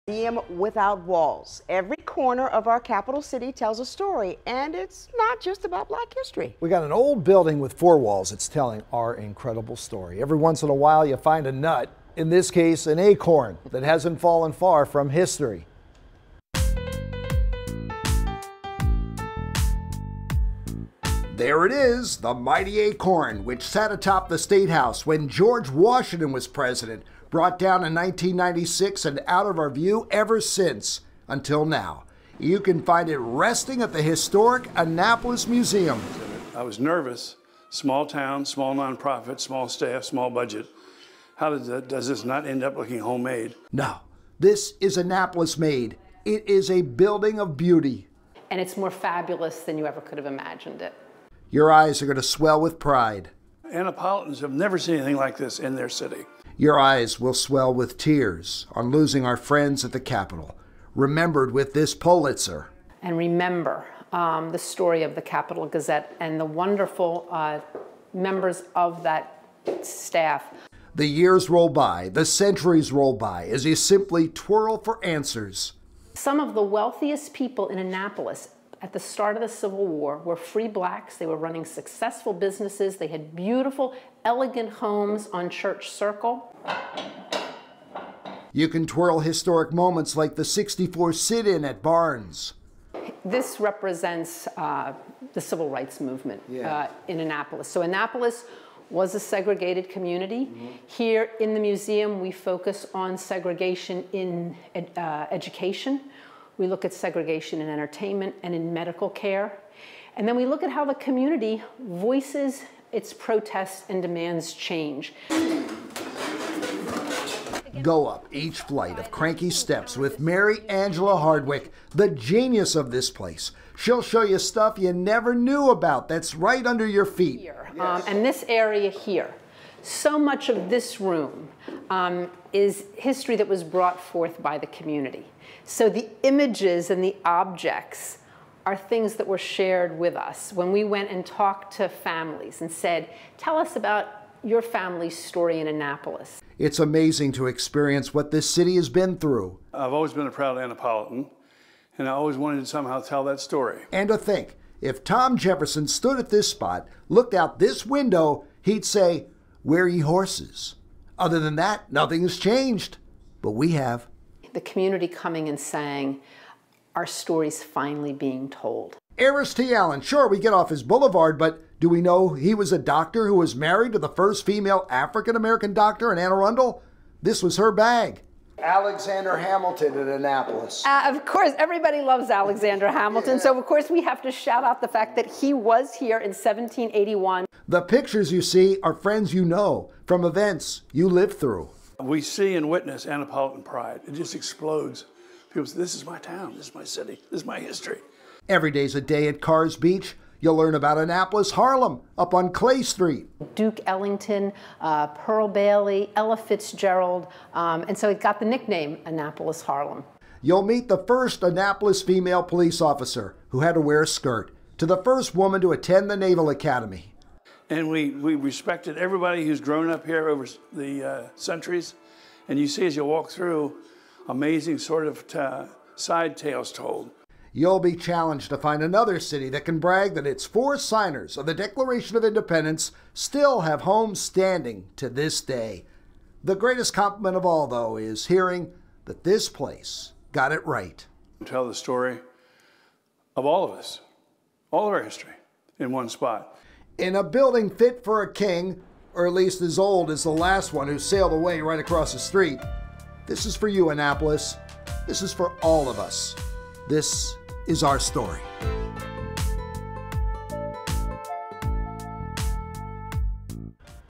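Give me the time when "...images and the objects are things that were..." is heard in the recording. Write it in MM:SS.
02:16.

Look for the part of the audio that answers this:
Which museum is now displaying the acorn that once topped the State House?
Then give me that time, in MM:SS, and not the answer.
00:34.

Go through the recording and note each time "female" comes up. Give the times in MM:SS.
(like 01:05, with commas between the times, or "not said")
02:54, 03:32.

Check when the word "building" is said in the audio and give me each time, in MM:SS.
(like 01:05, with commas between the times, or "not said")
00:07, 00:46, 04:07.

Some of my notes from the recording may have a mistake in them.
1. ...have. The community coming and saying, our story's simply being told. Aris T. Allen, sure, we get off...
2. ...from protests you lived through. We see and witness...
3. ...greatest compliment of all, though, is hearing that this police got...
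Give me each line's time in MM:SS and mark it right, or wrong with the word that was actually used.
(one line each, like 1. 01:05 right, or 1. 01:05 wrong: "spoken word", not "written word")
1. 02:43 wrong: "finally", not "simply"
2. 03:10 wrong: "events", not "protests"
3. 03:56 wrong: "place", not "police".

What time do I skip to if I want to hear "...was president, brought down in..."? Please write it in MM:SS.
00:26.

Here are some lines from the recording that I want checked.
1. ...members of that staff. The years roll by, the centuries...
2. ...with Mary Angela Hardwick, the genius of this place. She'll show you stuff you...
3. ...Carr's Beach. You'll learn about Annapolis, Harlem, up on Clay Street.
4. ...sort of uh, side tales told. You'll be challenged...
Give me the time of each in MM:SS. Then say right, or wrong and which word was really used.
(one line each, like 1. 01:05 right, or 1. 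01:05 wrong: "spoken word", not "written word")
1. 01:08 right
2. 01:59 right
3. 03:19 right
4. 03:44 right.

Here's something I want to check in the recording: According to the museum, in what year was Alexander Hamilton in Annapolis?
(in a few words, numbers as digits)
1781.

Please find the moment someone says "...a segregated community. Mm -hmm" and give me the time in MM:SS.
01:39.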